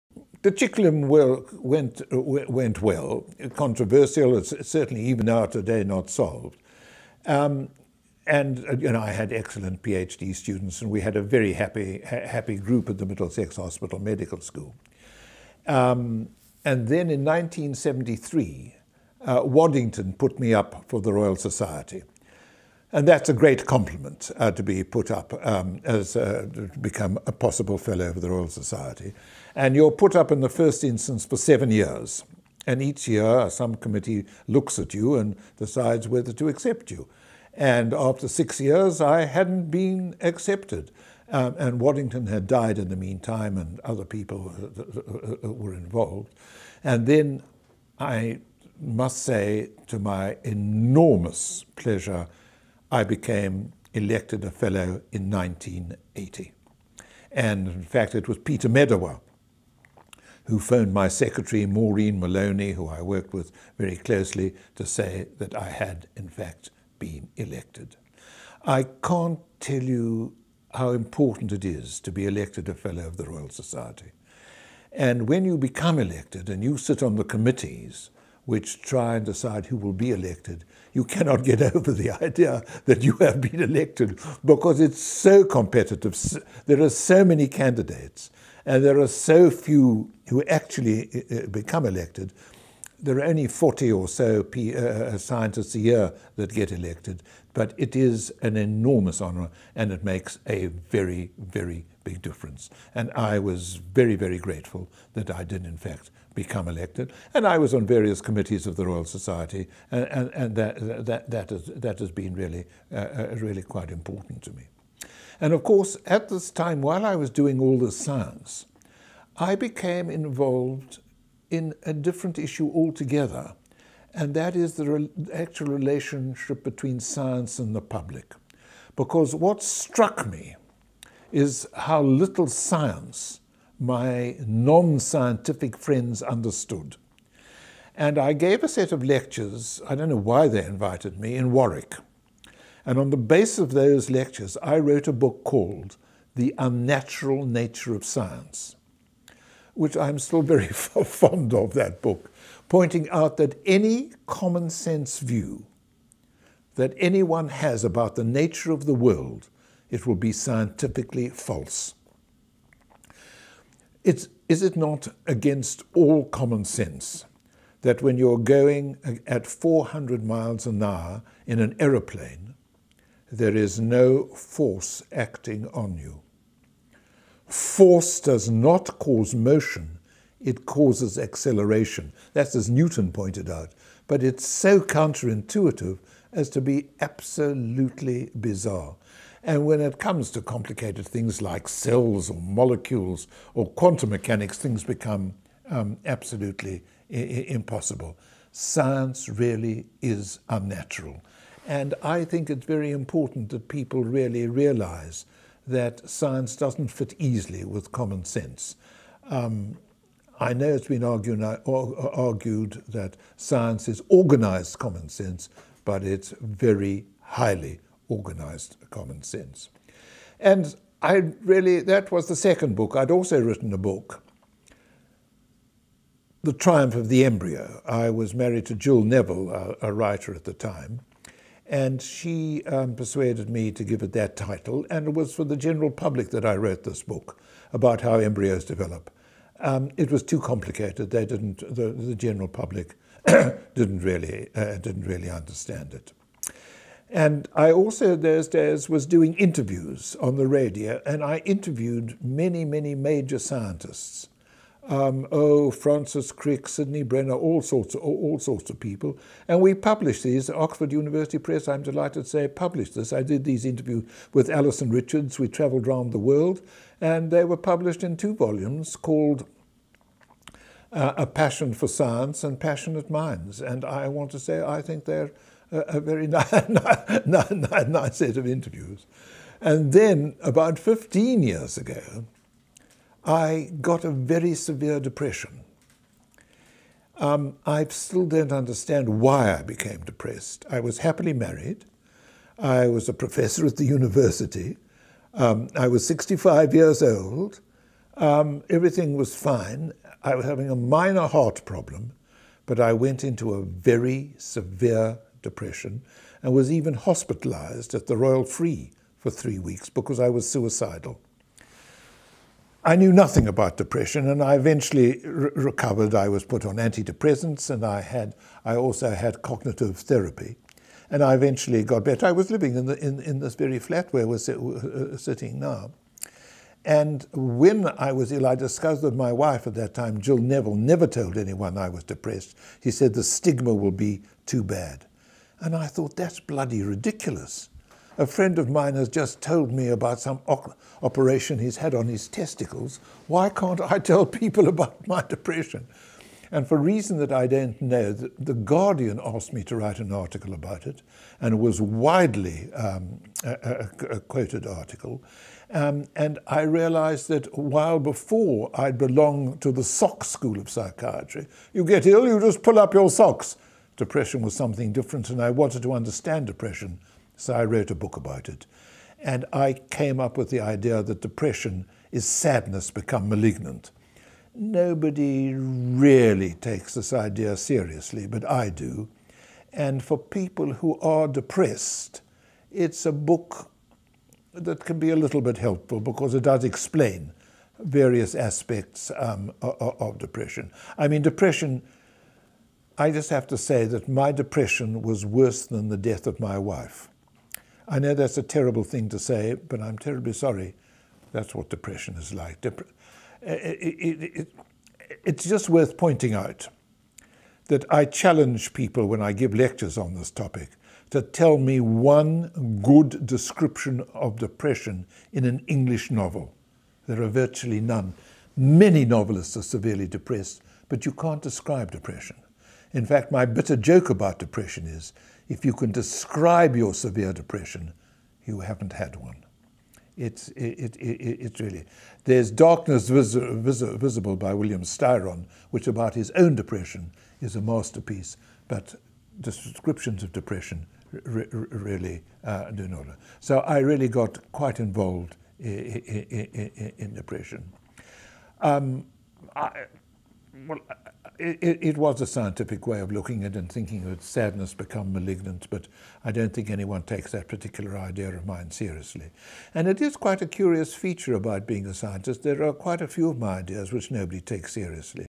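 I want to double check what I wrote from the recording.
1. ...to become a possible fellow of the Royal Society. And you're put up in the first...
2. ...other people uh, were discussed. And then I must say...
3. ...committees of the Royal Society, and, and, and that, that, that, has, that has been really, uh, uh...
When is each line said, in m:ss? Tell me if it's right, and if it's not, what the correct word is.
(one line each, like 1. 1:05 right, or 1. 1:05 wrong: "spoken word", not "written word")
1. 0:26 right
2. 0:43 wrong: "involved", not "discussed"
3. 1:48 right.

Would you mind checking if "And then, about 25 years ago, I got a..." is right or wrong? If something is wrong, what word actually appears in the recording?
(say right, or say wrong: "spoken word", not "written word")
wrong: "15", not "25".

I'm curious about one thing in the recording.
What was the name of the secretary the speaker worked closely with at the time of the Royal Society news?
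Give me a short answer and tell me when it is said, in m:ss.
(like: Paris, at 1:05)
Maureen Maloney, at 1:01.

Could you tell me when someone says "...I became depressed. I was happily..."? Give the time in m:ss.
4:49.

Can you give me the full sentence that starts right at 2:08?
Because what struck me is how little science my non scientific friends understood.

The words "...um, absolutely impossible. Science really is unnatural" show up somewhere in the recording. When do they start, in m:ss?
3:15.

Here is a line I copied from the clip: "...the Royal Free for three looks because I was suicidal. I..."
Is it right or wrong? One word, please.
wrong.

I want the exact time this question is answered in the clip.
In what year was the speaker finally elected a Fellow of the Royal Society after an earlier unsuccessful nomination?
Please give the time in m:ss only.
0:55.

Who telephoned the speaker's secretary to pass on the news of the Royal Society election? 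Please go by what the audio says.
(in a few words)
Peter Medawar.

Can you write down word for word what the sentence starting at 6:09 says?
And I came up with the idea that depression is sadness become malignant.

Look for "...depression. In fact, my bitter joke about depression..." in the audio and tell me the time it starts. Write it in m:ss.
7:01.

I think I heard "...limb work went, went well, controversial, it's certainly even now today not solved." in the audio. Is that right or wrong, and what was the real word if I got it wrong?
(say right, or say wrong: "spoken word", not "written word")
right.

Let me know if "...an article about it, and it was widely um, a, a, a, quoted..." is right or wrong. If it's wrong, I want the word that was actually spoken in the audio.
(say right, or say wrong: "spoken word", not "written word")
right.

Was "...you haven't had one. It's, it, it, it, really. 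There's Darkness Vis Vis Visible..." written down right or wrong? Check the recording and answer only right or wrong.
right.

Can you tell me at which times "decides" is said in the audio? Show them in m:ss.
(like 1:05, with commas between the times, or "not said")
0:35, 1:19.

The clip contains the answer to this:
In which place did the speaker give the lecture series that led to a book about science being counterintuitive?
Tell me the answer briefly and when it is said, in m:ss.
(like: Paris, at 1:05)
Warwick, at 2:21.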